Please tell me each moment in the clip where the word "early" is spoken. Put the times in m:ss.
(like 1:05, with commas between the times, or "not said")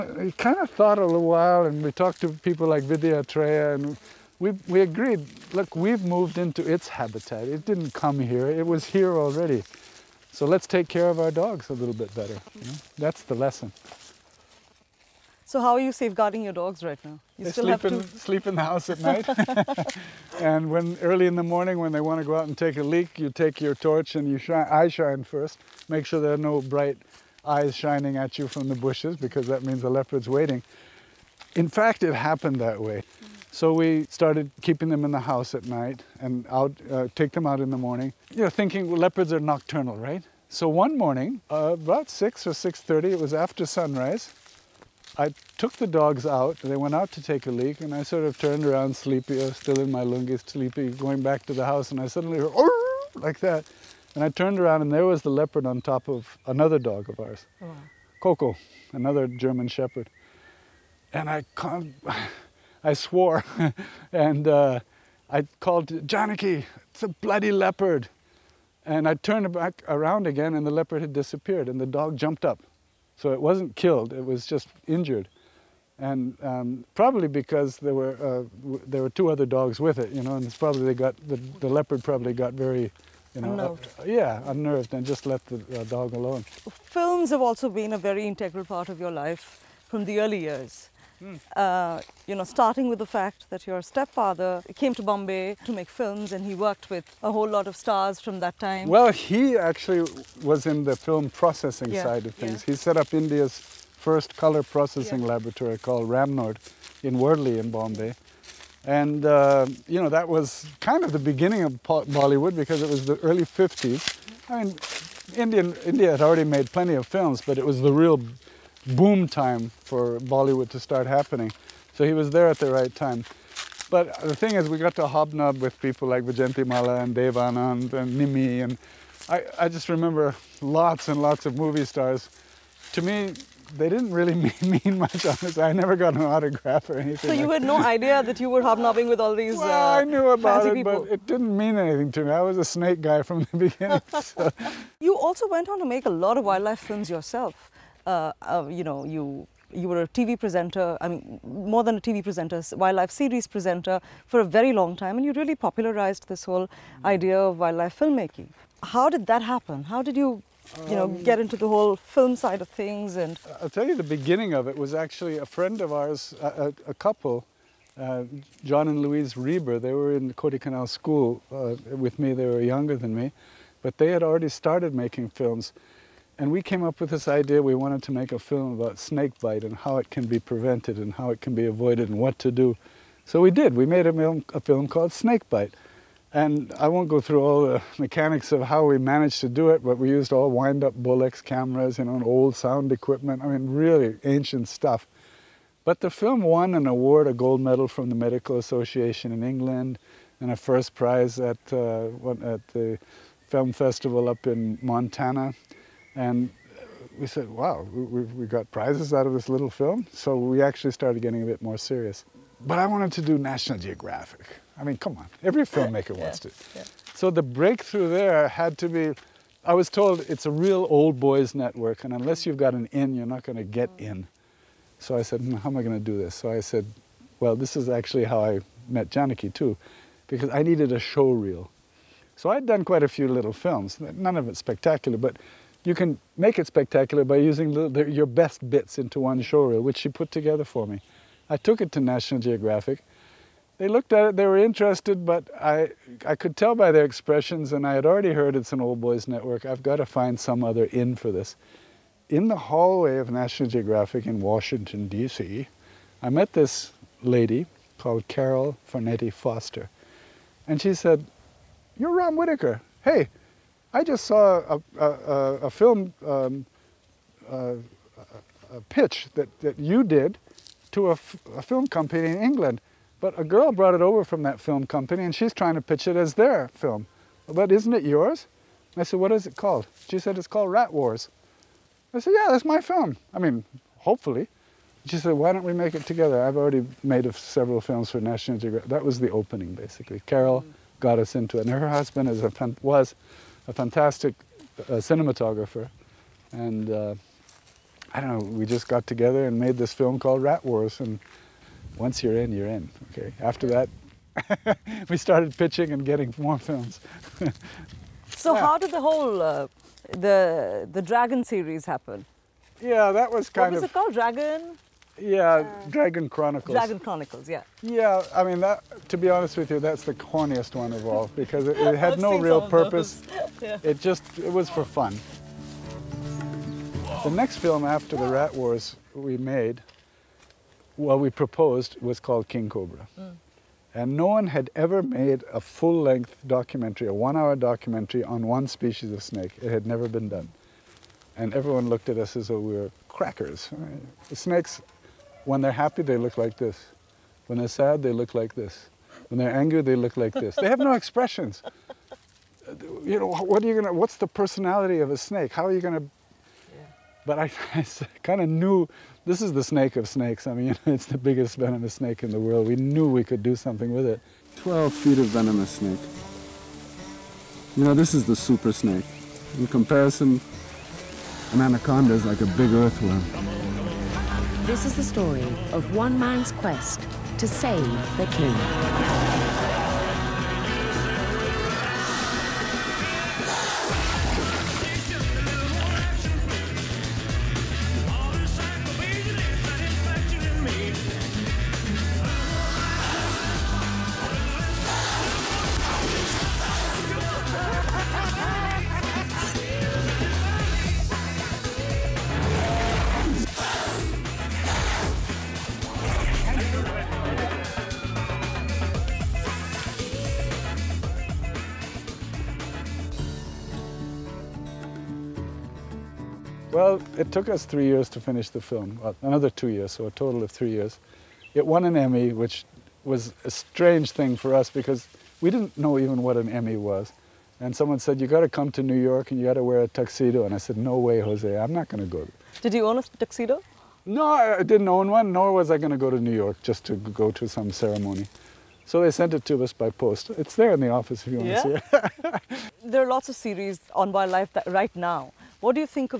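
0:21, 1:30, 1:53.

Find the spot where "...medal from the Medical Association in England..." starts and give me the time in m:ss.
3:17.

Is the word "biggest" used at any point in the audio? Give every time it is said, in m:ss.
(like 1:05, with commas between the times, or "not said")
6:01.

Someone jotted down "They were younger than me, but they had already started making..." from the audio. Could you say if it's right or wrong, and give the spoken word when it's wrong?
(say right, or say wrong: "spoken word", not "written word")
right.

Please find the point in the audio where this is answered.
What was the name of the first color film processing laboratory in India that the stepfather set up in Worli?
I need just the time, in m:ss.
1:46.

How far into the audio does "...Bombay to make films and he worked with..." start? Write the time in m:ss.
1:35.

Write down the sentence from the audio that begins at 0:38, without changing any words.
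You know, thinking well, leopards are nocturnal, right?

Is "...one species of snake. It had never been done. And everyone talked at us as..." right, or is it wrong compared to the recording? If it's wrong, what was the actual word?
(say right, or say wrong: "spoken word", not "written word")
wrong: "looked", not "talked".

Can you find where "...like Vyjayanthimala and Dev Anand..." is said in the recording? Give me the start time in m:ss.
2:06.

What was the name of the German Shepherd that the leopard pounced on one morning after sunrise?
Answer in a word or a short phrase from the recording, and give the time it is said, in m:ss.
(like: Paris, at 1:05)
Coco, at 0:58.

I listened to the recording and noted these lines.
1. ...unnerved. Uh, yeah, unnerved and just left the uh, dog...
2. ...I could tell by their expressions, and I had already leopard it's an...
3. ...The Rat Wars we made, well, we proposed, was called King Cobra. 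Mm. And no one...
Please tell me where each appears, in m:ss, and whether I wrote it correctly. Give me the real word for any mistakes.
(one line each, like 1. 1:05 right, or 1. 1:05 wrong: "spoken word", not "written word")
1. 1:23 right
2. 4:06 wrong: "heard", not "leopard"
3. 5:28 right.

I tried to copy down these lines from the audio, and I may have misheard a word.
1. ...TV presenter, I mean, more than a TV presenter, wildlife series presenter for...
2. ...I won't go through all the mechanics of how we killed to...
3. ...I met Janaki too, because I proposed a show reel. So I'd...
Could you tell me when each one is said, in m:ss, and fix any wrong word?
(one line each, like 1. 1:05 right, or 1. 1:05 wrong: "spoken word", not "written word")
1. 2:30 right
2. 3:06 wrong: "managed", not "killed"
3. 3:48 wrong: "needed", not "proposed".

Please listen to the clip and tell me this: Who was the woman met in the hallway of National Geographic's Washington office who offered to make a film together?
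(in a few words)
Carol Farneti Foster.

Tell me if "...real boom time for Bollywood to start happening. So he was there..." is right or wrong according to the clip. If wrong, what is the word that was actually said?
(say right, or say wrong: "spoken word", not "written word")
right.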